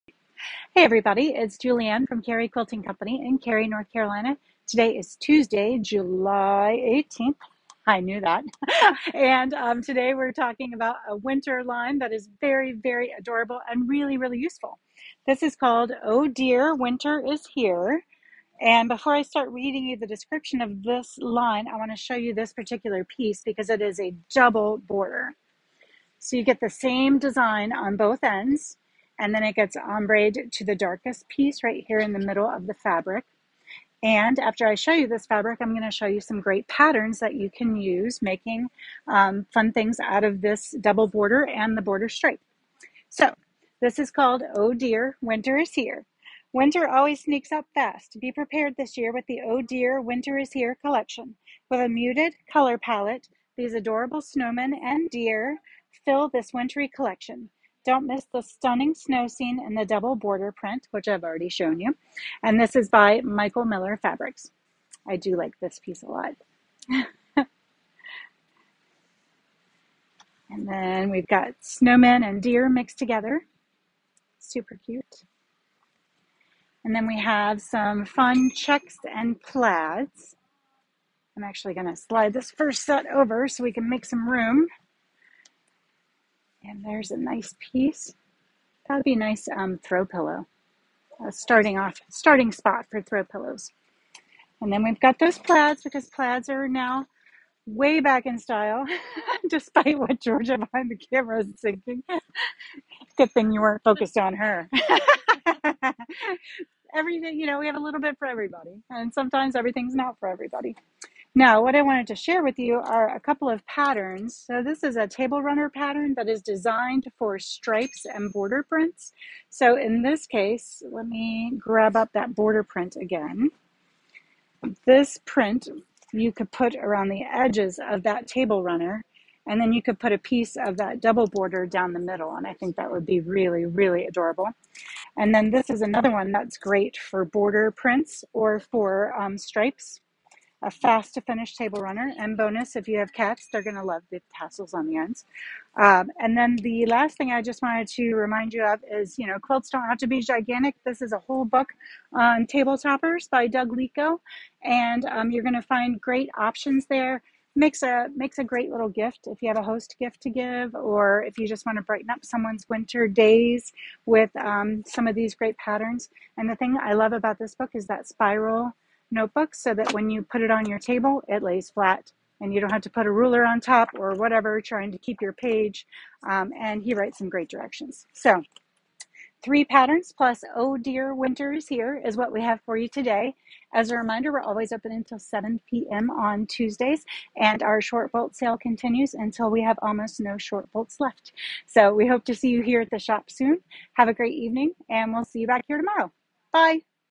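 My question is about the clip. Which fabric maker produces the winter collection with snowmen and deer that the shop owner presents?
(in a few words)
Michael Miller Fabrics.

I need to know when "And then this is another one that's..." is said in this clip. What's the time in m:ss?
2:15.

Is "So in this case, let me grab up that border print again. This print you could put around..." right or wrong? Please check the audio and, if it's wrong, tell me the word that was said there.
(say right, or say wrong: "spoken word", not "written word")
right.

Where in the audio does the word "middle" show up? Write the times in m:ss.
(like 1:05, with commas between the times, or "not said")
0:32, 2:11.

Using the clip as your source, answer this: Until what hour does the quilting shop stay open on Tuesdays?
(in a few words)
7 p.m.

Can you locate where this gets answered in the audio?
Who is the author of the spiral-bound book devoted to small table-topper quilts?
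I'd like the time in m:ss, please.
2:33.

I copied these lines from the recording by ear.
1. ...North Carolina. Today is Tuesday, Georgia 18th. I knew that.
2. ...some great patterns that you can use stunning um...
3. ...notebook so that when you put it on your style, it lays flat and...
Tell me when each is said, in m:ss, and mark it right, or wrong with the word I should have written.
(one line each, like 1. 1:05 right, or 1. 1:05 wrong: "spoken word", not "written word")
1. 0:03 wrong: "July", not "Georgia"
2. 0:36 wrong: "making", not "stunning"
3. 2:49 wrong: "table", not "style".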